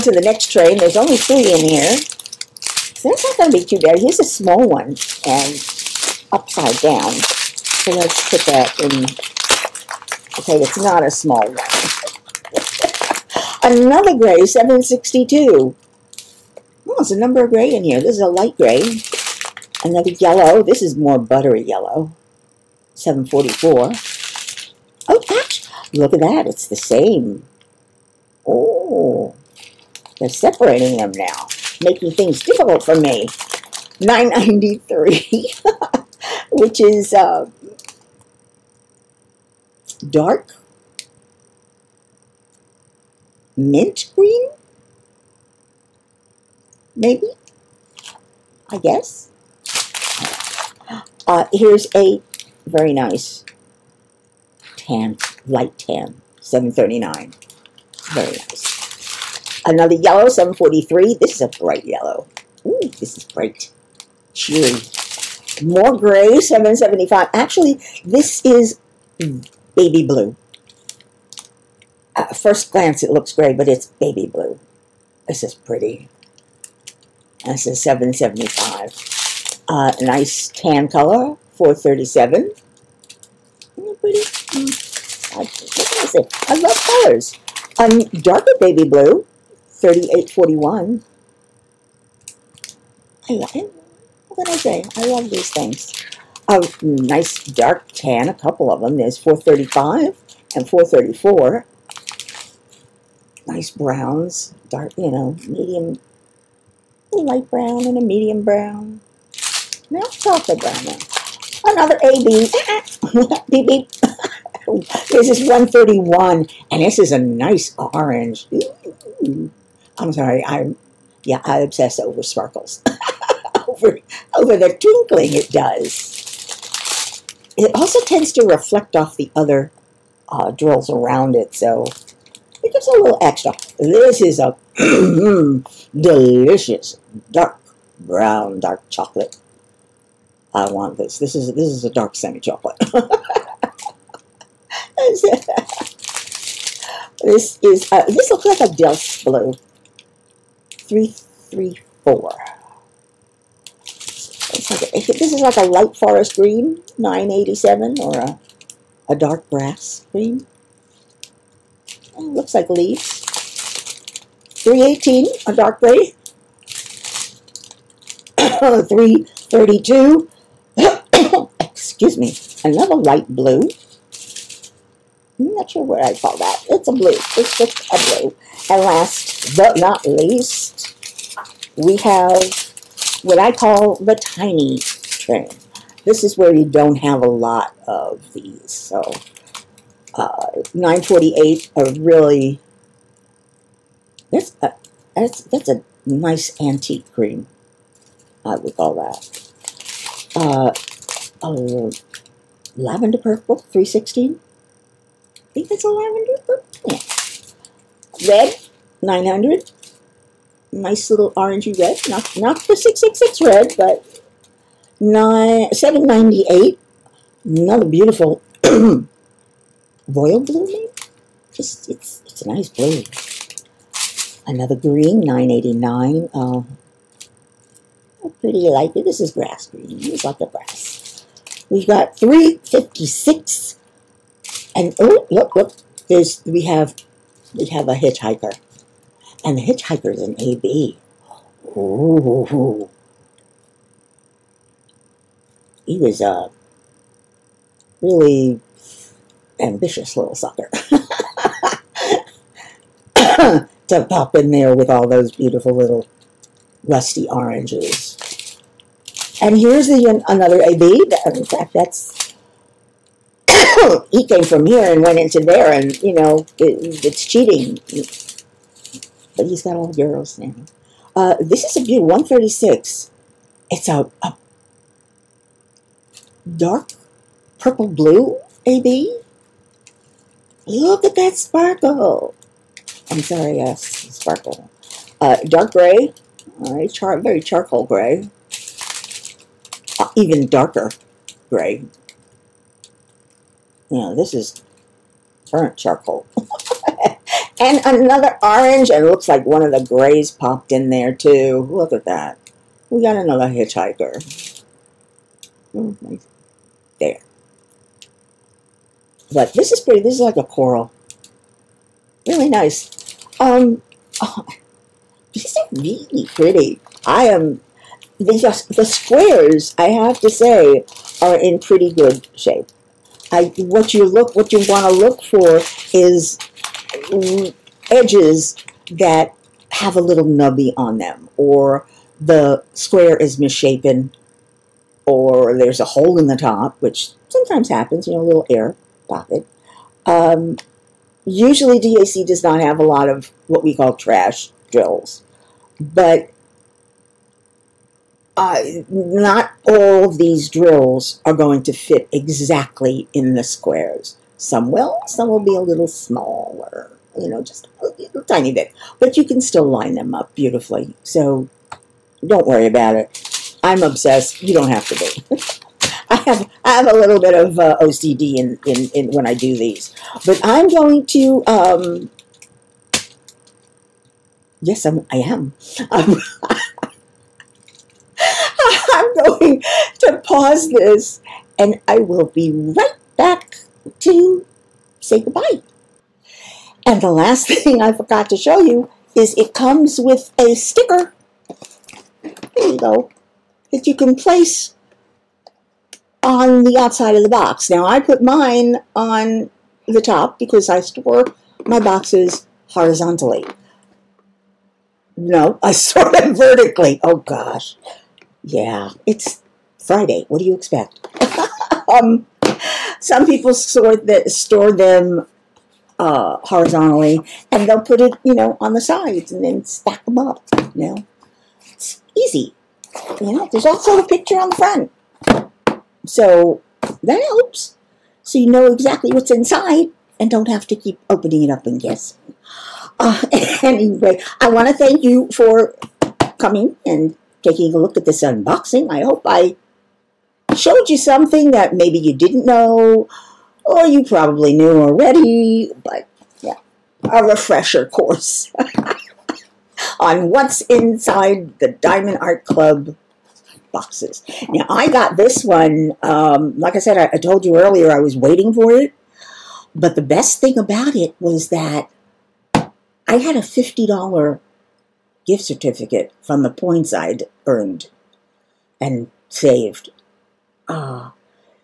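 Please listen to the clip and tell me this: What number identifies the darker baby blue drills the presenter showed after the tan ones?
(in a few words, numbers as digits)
3841.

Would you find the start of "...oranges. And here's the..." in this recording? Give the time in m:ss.
4:17.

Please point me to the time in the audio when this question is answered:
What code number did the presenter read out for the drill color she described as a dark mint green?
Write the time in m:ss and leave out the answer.
0:33.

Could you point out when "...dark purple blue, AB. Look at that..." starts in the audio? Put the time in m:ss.
4:36.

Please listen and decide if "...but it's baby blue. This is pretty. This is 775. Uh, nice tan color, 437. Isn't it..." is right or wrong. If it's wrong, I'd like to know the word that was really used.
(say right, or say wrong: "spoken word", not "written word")
right.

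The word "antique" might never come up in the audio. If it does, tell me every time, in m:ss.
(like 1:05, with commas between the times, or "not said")
3:16.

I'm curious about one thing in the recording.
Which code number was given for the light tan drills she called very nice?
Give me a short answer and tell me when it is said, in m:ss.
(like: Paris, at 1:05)
739, at 0:56.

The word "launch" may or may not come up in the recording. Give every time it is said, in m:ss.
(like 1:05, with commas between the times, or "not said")
not said.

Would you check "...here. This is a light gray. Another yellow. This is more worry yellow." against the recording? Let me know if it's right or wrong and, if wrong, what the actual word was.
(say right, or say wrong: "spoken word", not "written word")
wrong: "buttery", not "worry".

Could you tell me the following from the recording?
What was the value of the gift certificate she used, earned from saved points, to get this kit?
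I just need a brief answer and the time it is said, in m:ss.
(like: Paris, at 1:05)
$50, at 7:43.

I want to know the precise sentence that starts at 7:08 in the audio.
So you know exactly what's inside and don't have to keep opening it up and guessing.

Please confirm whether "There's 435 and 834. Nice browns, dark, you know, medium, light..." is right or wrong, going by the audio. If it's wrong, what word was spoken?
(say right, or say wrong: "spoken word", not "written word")
wrong: "434", not "834".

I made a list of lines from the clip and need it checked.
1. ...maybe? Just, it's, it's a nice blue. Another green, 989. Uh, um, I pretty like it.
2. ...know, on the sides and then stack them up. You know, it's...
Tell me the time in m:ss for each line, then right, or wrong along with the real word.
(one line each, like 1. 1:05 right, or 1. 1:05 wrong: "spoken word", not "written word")
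1. 3:40 right
2. 6:58 right.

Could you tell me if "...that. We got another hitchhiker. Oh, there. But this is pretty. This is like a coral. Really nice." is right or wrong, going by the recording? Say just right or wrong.
right.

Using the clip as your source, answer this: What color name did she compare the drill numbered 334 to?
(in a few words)
Delft blue.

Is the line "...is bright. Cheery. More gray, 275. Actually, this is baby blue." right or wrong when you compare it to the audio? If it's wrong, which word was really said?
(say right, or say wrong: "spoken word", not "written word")
wrong: "775", not "275".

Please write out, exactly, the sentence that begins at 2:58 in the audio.
And last but not least, we have what I call the tiny train.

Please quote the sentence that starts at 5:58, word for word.
But you can still line them up beautifully, so don't worry about it.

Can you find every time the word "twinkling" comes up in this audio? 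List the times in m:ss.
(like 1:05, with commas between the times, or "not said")
2:04.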